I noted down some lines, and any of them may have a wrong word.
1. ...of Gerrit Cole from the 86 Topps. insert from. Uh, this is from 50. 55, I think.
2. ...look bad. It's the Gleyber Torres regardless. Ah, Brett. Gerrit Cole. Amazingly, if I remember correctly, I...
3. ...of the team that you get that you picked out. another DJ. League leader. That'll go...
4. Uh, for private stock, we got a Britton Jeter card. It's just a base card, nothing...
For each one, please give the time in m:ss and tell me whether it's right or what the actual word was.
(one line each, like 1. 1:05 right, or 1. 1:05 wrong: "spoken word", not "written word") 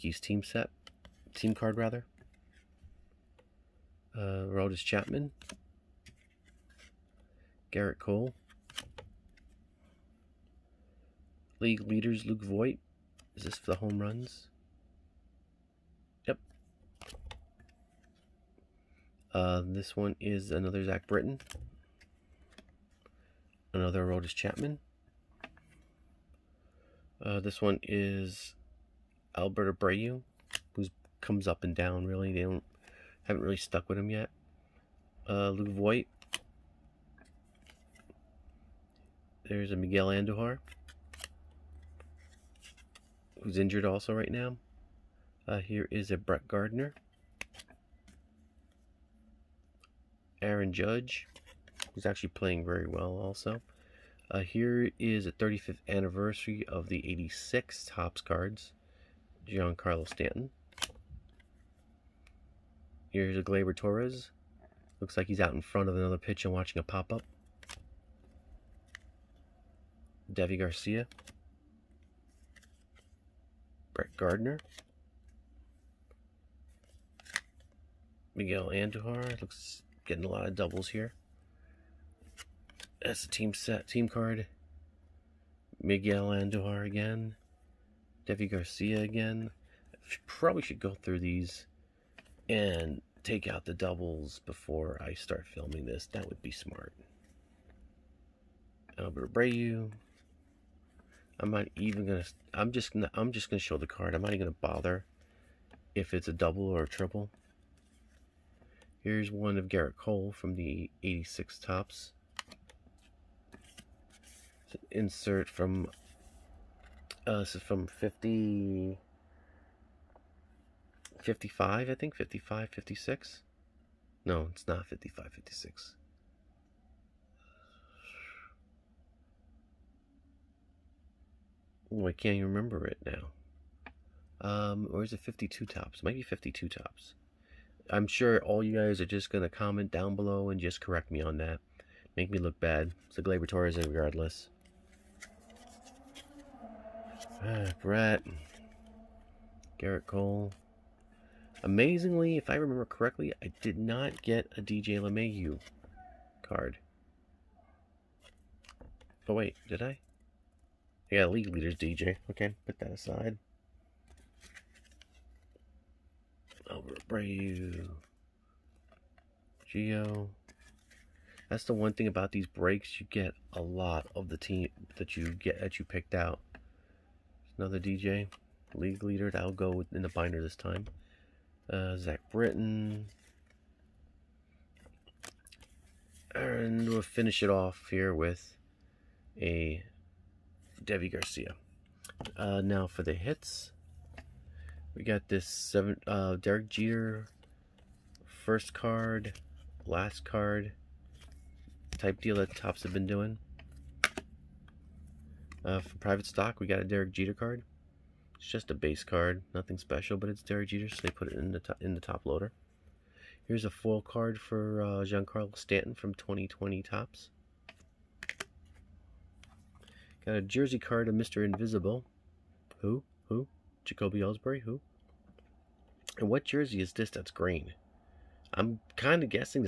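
1. 1:49 right
2. 2:22 right
3. 2:54 right
4. 3:25 wrong: "Derek", not "Britton".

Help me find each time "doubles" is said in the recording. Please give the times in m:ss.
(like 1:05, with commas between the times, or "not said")
1:20, 1:33, 1:46.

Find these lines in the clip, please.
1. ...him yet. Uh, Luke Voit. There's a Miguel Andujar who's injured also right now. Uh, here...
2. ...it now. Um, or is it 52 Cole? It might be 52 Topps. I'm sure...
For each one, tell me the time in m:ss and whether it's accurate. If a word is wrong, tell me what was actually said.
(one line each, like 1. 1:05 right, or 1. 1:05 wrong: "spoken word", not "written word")
1. 0:33 right
2. 2:12 wrong: "Topps", not "Cole".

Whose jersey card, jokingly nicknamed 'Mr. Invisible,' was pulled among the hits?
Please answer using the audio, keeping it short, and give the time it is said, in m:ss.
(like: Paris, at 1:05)
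Jacoby Ellsbury, at 3:43.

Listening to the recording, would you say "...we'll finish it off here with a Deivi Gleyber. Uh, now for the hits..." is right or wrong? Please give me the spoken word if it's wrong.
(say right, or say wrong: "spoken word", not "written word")
wrong: "Garcia", not "Gleyber".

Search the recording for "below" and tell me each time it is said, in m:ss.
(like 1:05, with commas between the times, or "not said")
2:20.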